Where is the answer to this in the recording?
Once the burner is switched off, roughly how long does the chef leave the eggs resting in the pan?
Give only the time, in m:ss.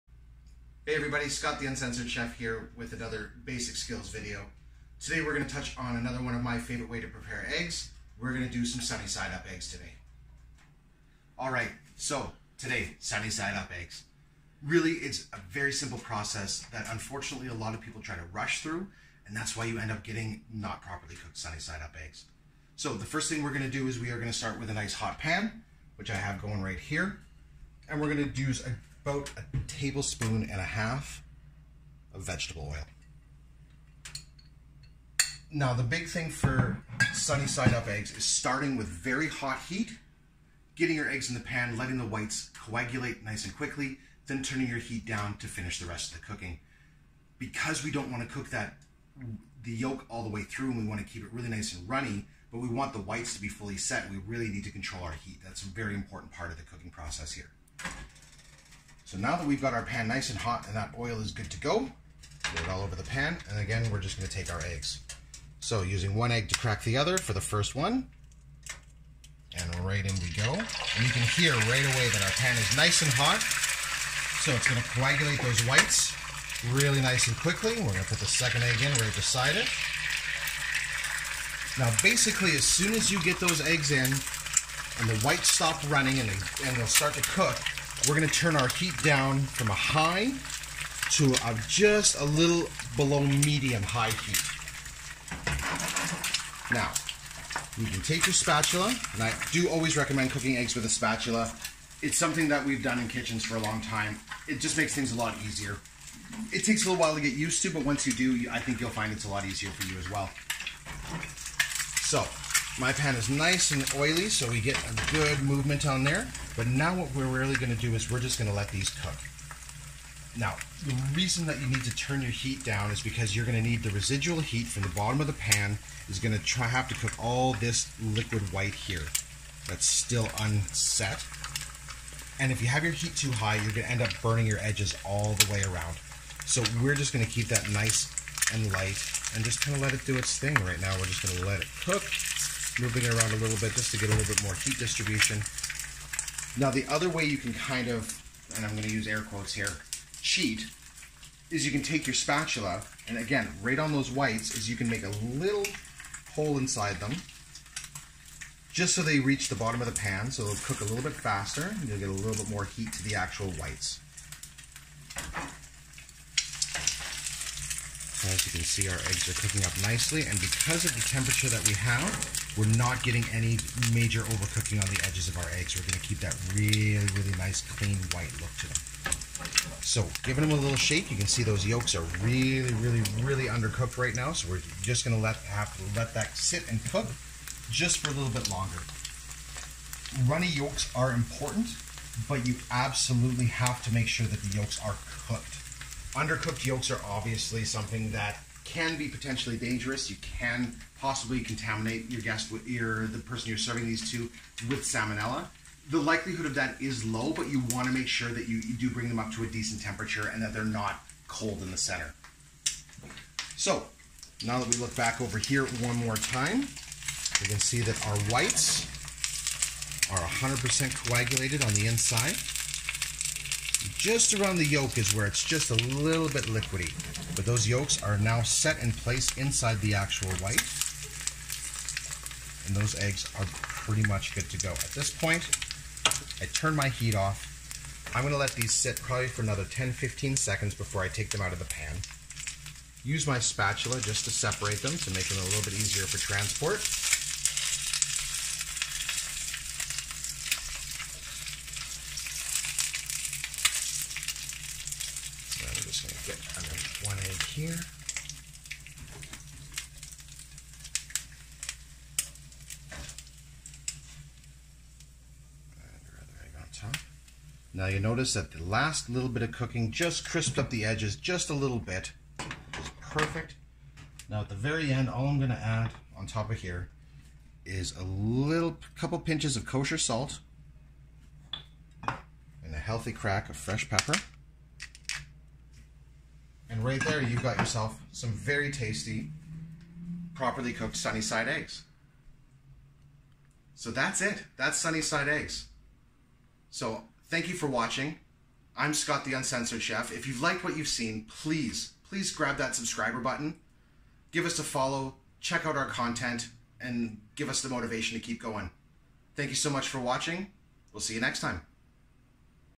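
3:59.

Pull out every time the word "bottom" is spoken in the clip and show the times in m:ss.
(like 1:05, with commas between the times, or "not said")
2:04, 2:39.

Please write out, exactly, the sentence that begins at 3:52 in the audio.
And those eggs are pretty much good to go.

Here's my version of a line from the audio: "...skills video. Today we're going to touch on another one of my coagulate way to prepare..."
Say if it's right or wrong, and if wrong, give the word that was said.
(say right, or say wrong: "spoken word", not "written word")
wrong: "favorite", not "coagulate".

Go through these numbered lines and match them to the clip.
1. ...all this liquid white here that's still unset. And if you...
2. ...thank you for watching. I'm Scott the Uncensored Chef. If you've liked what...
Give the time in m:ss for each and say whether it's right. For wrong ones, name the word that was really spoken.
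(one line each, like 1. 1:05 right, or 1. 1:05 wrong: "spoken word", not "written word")
1. 2:07 right
2. 4:57 right.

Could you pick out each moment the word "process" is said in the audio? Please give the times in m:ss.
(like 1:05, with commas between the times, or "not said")
0:15, 0:56.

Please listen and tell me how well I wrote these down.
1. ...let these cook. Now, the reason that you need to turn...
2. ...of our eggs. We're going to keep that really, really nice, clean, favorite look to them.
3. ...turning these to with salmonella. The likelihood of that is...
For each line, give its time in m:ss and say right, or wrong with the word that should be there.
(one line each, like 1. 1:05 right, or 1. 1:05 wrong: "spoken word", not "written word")
1. 1:58 right
2. 2:55 wrong: "white", not "favorite"
3. 3:23 wrong: "serving", not "turning".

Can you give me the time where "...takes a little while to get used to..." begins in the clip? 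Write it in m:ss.
1:46.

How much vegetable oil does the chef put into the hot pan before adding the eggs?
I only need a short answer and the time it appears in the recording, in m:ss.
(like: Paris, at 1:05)
1.5 tablespoons, at 0:29.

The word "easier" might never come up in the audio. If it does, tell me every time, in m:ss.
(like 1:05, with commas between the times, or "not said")
1:45, 1:49, 4:05.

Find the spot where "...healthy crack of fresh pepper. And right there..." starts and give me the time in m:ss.
4:42.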